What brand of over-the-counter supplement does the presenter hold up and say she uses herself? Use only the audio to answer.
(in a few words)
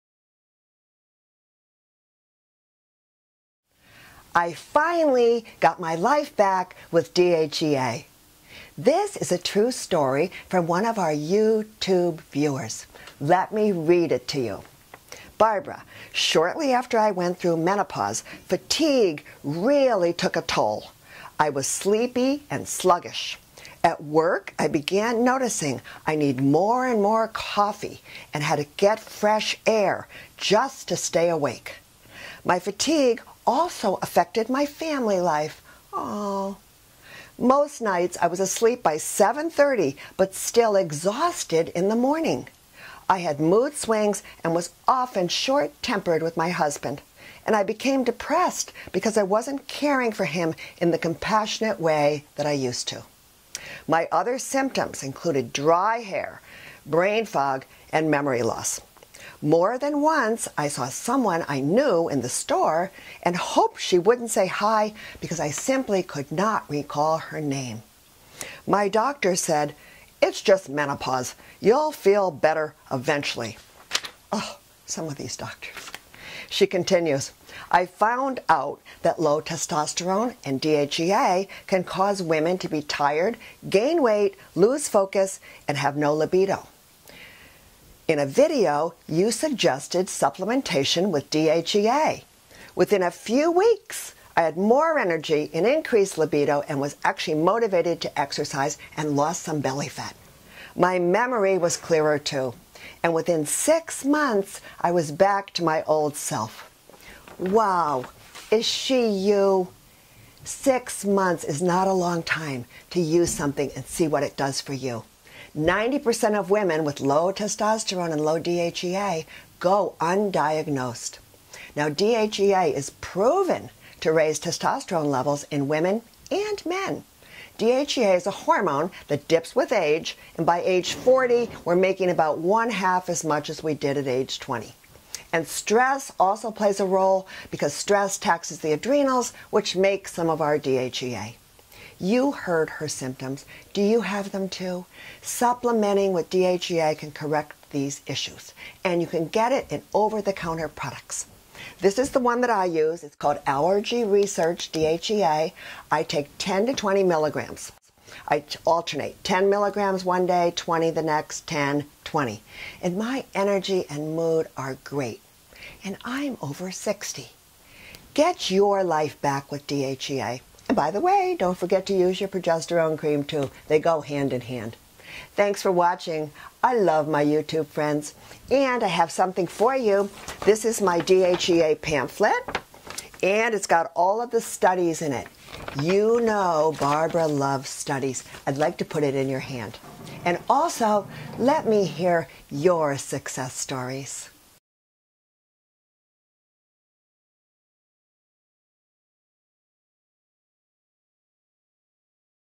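Allergy Research.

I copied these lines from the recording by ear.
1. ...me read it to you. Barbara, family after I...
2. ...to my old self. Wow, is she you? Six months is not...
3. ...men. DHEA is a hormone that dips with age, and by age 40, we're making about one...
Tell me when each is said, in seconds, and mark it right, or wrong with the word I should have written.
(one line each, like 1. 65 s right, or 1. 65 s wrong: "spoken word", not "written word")
1. 13 s wrong: "shortly", not "family"
2. 105 s right
3. 126 s right.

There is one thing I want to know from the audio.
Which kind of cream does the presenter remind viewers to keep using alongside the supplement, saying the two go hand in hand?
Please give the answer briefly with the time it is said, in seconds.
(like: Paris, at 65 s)
progesterone cream, at 172 s.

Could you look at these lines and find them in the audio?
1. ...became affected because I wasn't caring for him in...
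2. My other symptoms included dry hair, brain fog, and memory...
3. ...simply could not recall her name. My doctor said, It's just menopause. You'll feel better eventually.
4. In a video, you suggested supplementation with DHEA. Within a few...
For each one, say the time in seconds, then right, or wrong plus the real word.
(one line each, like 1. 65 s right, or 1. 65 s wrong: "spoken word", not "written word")
1. 47 s wrong: "depressed", not "affected"
2. 53 s right
3. 65 s right
4. 88 s right.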